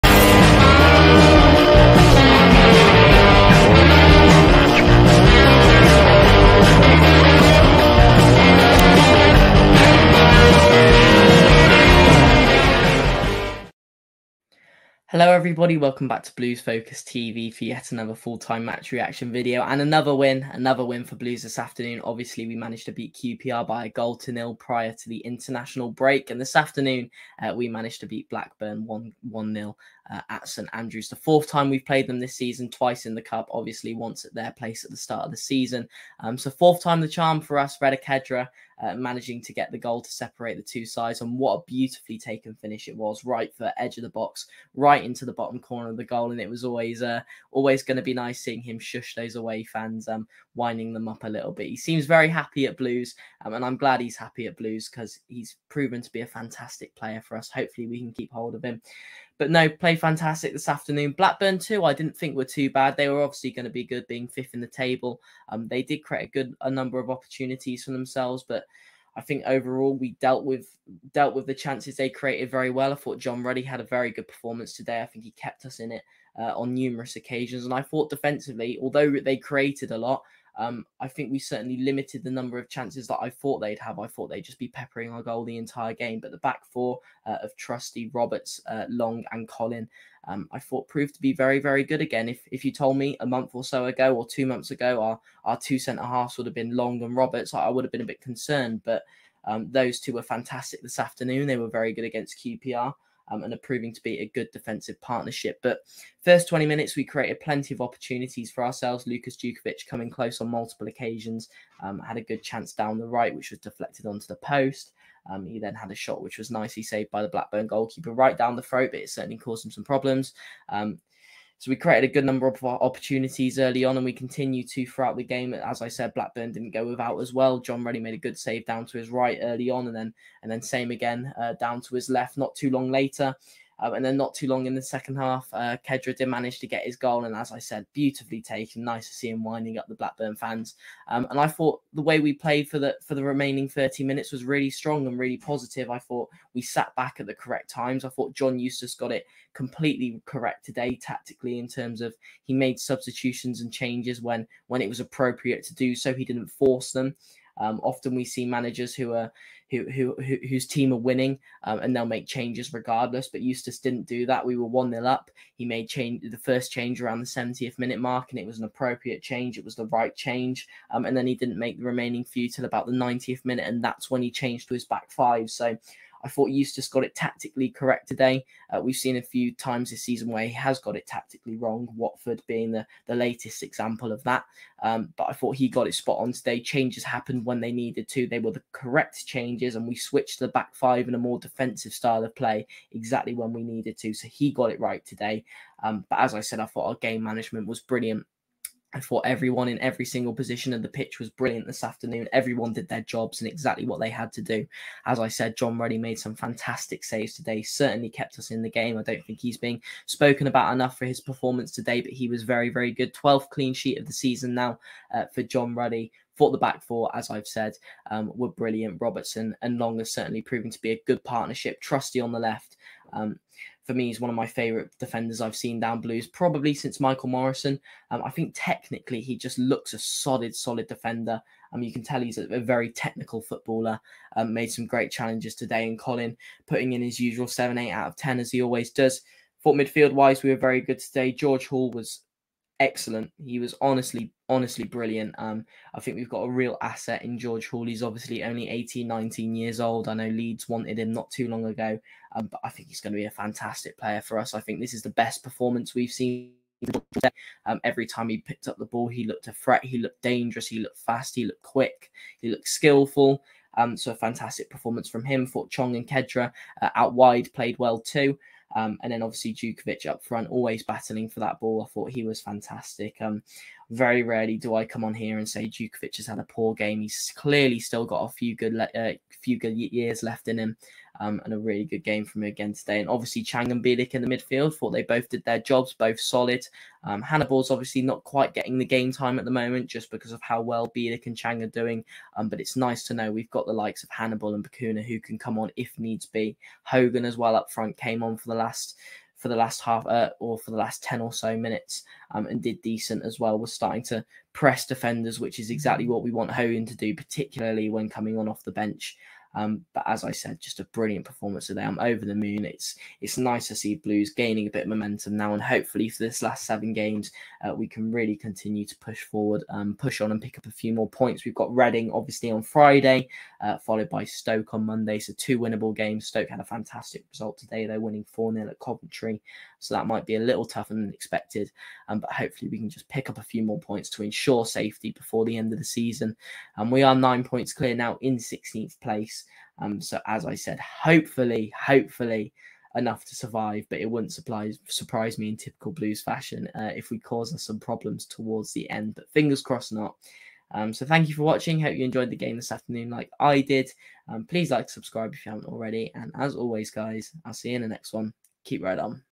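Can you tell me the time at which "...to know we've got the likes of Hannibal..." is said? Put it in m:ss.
4:53.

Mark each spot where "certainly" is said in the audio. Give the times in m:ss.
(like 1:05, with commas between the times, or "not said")
1:21, 1:59, 3:27, 3:40.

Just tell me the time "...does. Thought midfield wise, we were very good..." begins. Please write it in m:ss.
3:58.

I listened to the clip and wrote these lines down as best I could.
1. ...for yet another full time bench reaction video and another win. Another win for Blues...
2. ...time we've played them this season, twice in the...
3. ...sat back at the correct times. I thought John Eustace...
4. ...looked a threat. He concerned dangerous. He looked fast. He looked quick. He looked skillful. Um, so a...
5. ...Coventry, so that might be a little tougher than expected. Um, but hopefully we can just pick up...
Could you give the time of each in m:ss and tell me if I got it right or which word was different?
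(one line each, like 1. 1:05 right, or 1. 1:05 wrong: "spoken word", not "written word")
1. 0:17 wrong: "match", not "bench"
2. 0:31 right
3. 2:26 right
4. 4:19 wrong: "looked", not "concerned"
5. 5:28 right.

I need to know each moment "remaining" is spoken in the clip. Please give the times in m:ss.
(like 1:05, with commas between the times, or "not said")
2:23, 2:51.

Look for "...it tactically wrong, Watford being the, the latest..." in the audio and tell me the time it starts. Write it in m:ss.
3:00.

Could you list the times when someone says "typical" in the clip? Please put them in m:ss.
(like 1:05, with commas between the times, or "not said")
5:45.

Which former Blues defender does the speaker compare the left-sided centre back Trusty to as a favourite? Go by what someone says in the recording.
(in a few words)
Michael Morrison.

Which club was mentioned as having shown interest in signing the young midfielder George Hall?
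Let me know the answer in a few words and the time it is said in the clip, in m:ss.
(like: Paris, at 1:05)
Leeds, at 4:10.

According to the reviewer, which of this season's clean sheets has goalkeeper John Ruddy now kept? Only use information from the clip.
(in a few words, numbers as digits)
12th.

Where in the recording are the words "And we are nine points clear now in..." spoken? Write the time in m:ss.
5:36.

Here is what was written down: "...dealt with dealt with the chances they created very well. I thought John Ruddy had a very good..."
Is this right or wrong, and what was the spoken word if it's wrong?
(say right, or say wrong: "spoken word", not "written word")
right.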